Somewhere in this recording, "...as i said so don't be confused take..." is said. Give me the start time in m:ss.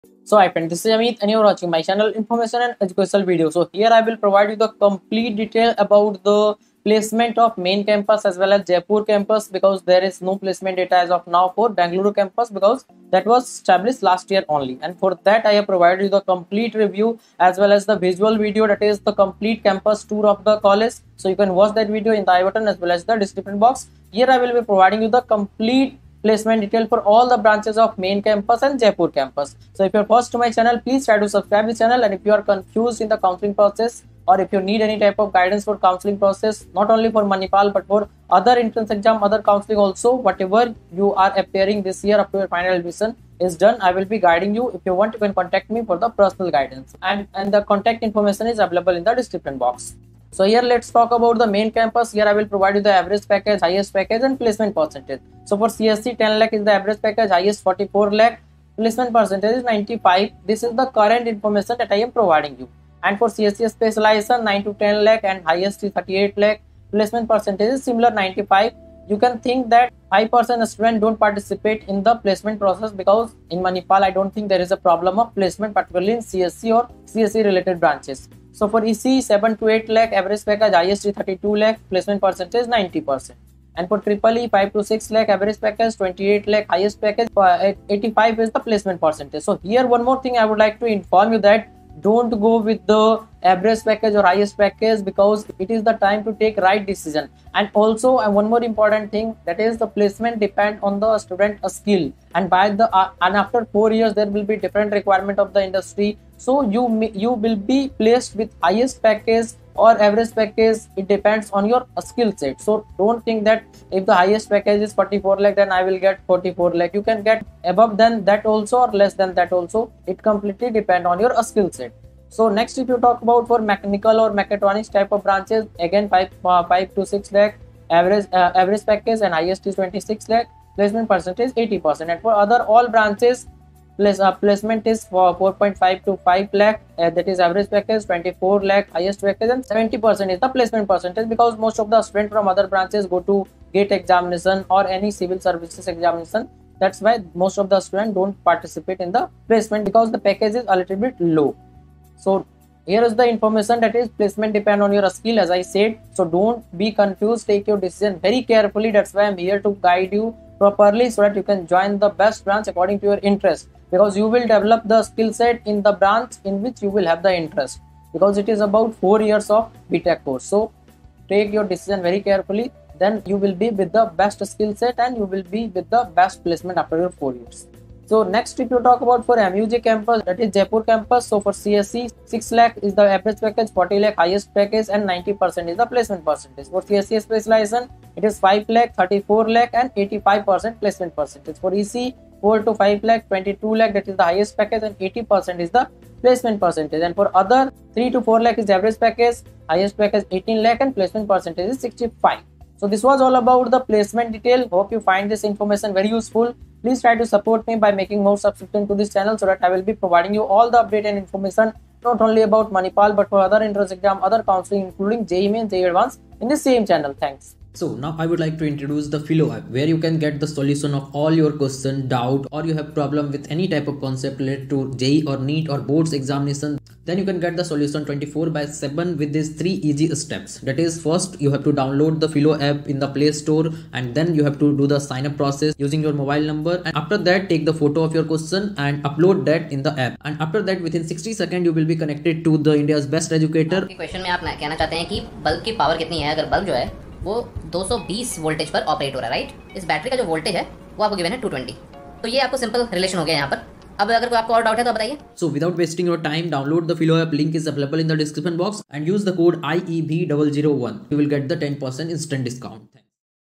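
2:35.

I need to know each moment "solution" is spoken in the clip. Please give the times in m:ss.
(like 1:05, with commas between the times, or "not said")
3:40, 3:47.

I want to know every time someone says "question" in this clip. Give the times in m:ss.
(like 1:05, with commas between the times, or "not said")
3:41, 3:58, 4:04.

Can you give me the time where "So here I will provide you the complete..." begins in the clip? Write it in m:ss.
0:03.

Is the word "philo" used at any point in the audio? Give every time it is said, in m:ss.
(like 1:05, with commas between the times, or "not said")
3:39, 3:52.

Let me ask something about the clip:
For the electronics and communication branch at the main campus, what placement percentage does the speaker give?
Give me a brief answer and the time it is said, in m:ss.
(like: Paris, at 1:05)
90 percent, at 1:21.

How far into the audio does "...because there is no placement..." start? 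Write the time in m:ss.
0:09.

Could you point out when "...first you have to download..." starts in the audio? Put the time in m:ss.
3:51.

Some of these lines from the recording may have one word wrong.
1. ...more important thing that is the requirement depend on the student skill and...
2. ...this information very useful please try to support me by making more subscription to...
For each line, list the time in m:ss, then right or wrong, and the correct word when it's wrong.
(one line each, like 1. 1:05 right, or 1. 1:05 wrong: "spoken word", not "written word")
1. 1:38 wrong: "placement", not "requirement"
2. 3:25 right.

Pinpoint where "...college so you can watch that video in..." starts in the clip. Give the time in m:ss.
0:20.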